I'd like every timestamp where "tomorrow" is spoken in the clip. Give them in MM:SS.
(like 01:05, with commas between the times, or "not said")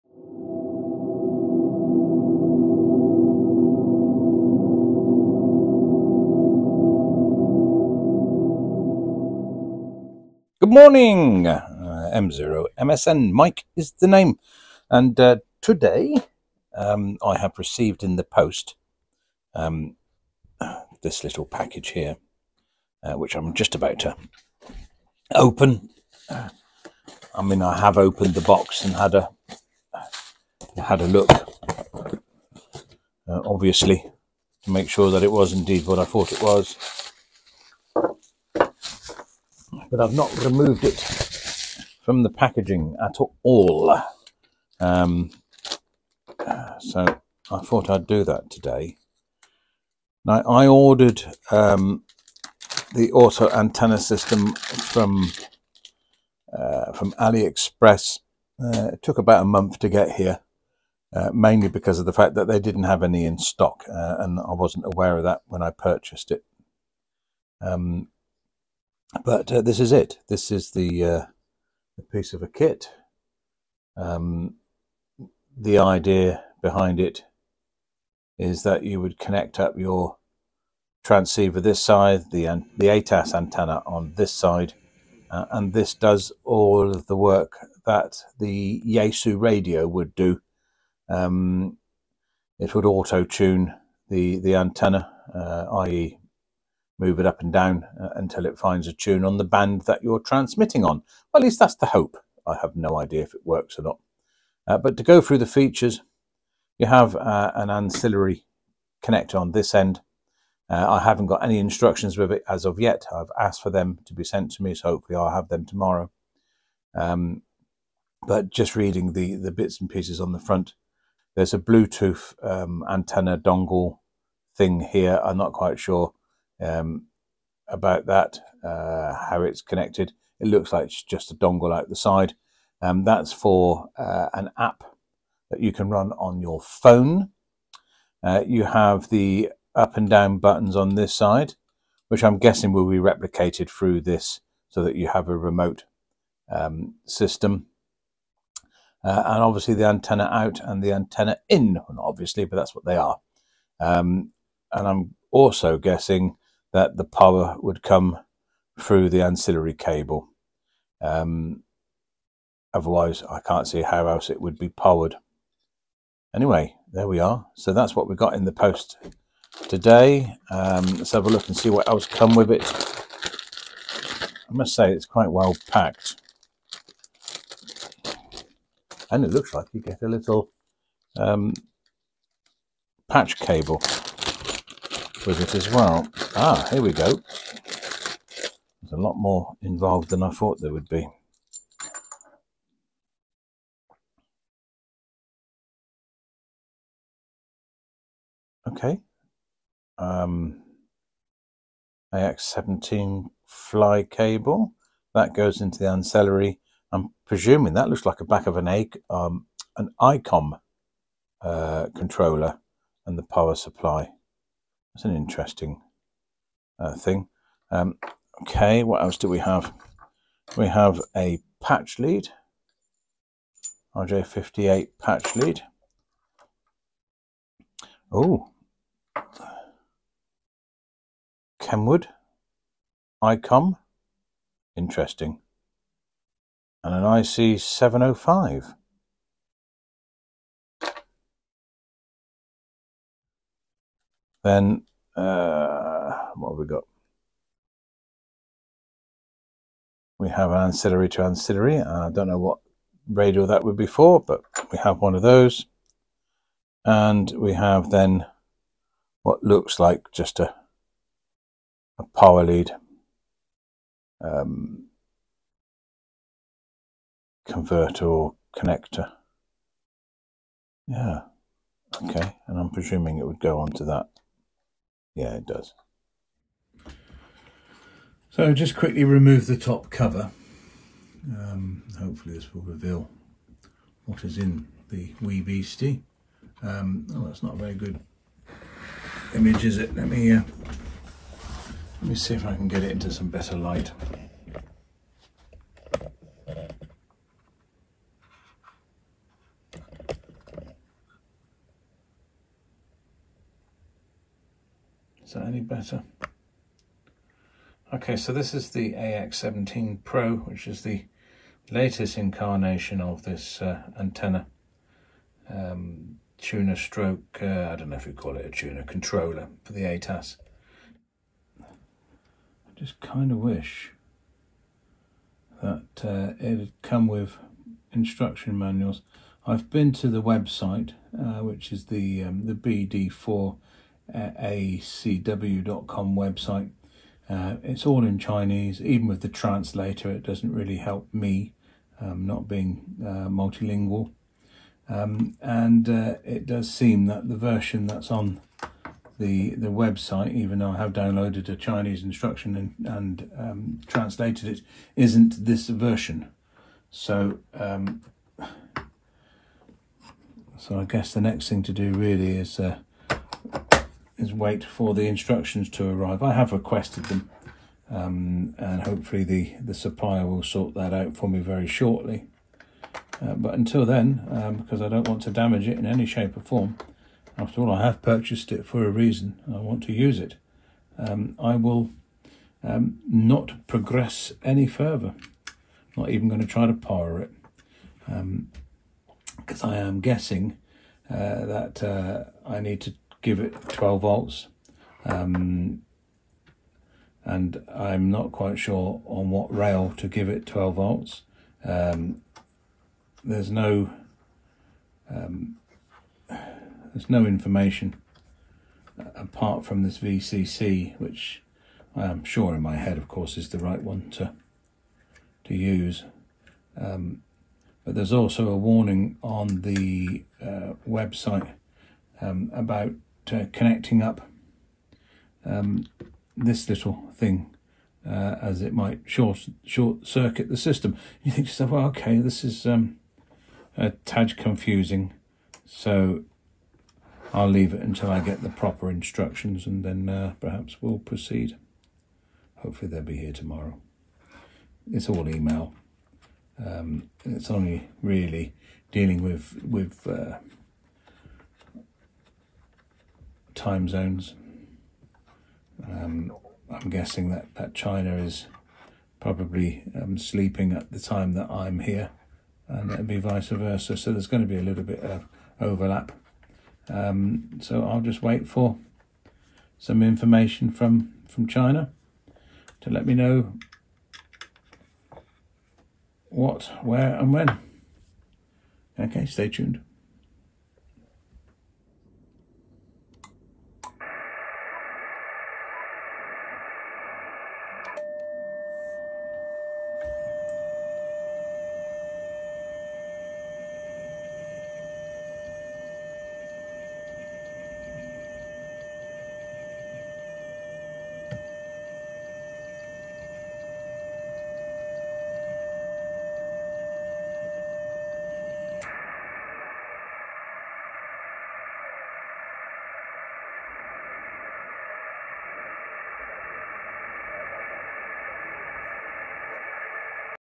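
01:55, 07:23.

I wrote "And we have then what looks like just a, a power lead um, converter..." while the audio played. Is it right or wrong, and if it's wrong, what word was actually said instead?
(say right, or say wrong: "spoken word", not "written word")
right.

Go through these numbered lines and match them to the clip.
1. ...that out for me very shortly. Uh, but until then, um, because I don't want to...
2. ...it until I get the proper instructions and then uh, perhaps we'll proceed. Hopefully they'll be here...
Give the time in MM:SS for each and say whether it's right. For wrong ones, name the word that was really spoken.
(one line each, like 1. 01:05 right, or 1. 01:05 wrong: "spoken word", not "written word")
1. 06:10 right
2. 07:17 right.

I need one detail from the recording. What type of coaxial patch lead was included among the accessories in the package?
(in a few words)
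RG58.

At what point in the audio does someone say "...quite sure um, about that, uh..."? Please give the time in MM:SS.
02:05.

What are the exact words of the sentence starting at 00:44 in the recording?
Um, so I thought I'd do that today.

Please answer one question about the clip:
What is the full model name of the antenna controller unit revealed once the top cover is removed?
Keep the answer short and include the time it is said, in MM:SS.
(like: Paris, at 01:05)
AX17 Pro, at 05:08.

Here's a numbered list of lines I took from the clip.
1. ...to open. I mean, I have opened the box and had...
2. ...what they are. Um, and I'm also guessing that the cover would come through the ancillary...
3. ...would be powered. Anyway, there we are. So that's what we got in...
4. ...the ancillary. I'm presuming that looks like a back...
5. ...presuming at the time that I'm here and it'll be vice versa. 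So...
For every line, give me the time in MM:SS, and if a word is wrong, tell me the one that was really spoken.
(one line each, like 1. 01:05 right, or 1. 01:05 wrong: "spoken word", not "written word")
1. 00:23 right
2. 02:32 wrong: "power", not "cover"
3. 02:44 right
4. 03:25 right
5. 07:40 wrong: "sleeping", not "presuming".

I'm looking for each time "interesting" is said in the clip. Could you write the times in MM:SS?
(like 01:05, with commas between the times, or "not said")
03:35, 03:54.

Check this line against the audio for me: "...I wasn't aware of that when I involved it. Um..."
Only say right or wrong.
wrong.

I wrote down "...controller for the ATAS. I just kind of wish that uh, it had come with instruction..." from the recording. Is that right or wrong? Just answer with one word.
right.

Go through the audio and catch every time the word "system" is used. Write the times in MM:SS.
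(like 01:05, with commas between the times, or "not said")
00:53, 02:27, 07:10.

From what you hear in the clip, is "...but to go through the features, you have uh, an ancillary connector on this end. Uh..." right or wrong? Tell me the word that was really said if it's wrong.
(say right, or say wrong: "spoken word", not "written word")
right.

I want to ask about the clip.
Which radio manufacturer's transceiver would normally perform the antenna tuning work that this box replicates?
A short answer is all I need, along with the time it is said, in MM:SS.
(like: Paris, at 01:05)
Yaesu, at 01:28.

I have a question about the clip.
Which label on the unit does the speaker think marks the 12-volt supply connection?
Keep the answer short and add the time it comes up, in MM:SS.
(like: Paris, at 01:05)
VCC, at 06:49.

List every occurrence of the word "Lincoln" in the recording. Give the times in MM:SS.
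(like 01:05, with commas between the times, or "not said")
not said.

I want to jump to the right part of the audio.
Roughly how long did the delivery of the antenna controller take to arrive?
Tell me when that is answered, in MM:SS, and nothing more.
00:59.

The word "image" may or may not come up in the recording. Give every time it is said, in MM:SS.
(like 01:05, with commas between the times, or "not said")
04:49.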